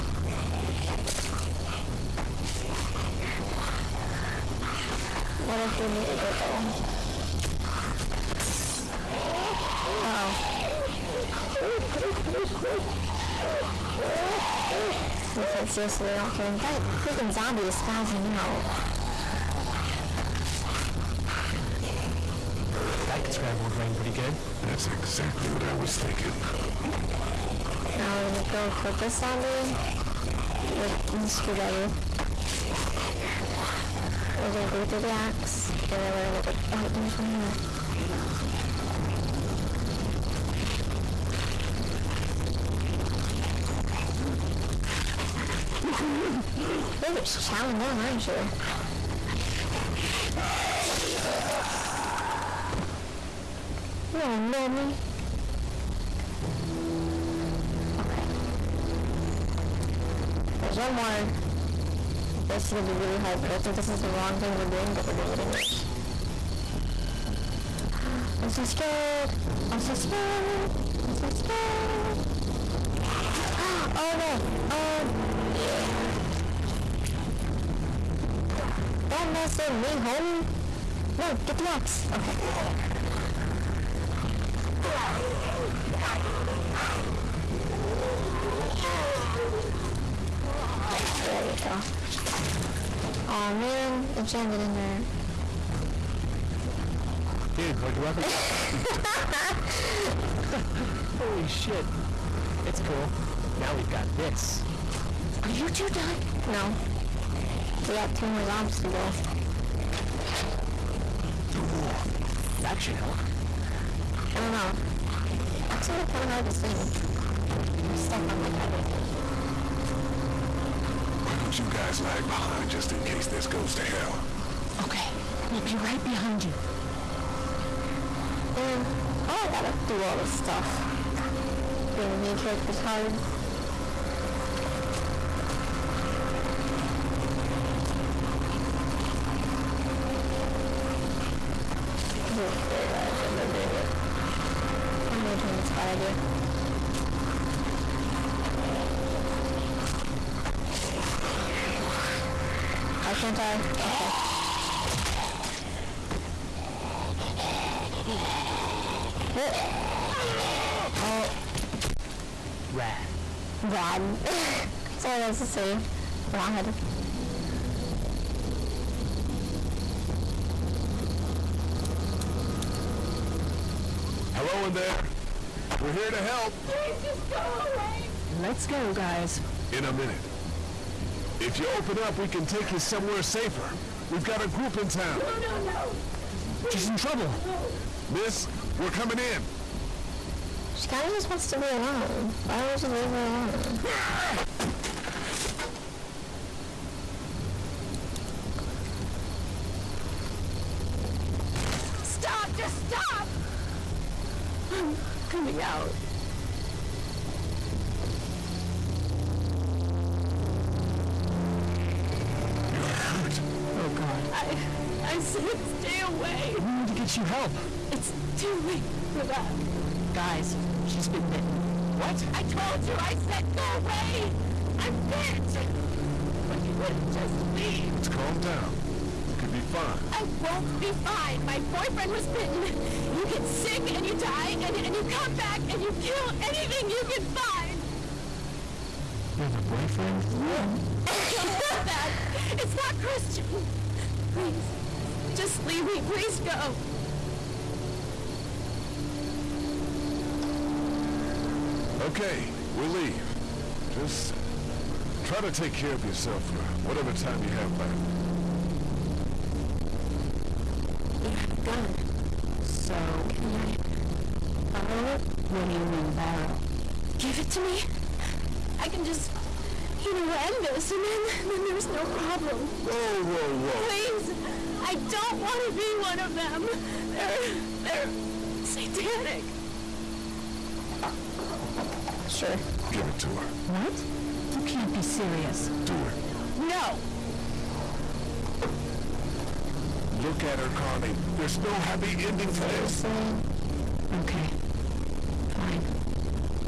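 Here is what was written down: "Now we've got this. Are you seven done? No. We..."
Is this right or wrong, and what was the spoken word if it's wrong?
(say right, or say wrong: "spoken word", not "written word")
wrong: "two", not "seven".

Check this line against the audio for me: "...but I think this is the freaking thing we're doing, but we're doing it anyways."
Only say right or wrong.
wrong.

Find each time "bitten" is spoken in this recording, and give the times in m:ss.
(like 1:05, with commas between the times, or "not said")
3:41, 3:52.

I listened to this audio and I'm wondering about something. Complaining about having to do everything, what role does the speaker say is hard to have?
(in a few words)
main character.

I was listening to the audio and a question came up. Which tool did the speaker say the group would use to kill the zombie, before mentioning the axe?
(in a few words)
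screwdriver.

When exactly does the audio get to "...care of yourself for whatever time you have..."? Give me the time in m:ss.
4:15.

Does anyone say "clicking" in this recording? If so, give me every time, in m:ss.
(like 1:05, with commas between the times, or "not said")
not said.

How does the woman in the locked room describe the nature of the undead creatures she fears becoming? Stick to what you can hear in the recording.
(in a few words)
satanic.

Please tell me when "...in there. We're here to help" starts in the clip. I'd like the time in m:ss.
2:54.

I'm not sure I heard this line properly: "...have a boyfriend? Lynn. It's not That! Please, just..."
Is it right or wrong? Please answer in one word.
wrong.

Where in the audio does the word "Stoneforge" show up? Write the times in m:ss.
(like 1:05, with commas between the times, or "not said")
not said.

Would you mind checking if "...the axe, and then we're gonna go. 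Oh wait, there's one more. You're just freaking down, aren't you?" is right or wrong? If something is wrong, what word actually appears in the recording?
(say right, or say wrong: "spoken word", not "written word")
wrong: "chowing", not "freaking".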